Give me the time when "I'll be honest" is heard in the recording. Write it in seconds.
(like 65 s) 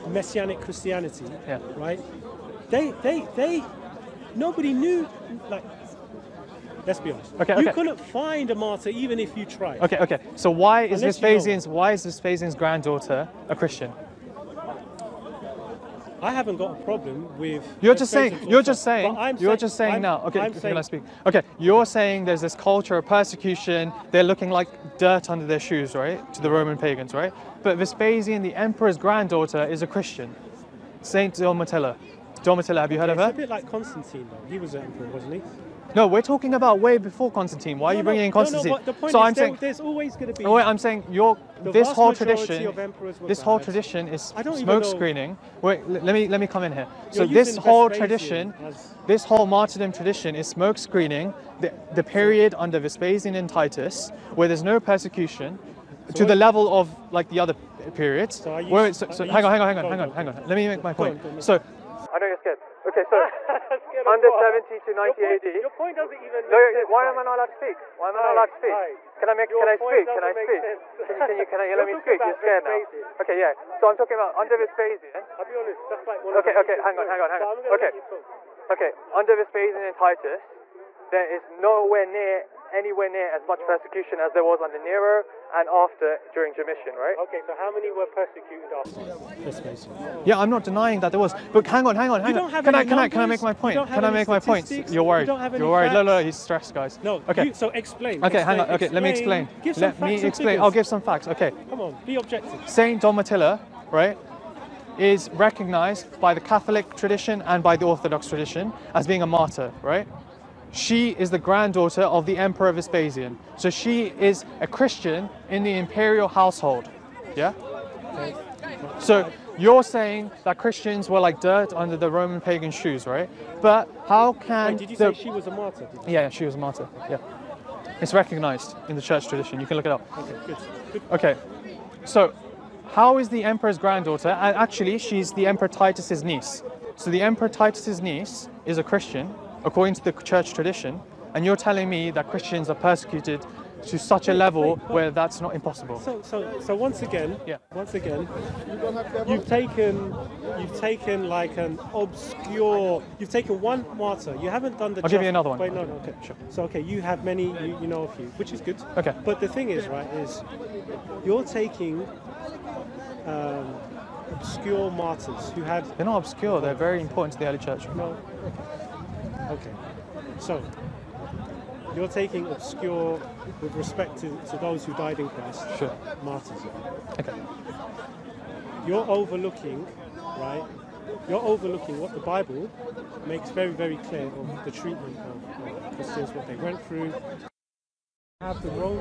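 75 s.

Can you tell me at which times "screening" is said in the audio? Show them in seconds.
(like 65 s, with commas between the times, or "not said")
44 s, 50 s.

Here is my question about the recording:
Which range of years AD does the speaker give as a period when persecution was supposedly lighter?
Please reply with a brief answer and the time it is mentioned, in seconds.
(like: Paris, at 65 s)
70 to 90, at 64 s.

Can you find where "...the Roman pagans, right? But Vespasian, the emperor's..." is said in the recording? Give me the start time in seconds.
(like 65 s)
26 s.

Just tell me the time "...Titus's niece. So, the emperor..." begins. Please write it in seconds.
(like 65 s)
135 s.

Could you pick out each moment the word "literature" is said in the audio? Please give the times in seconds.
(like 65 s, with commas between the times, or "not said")
not said.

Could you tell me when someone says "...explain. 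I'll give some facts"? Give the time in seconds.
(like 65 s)
100 s.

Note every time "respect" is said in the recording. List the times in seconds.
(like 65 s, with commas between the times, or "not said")
173 s.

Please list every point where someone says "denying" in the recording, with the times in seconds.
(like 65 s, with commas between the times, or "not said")
90 s.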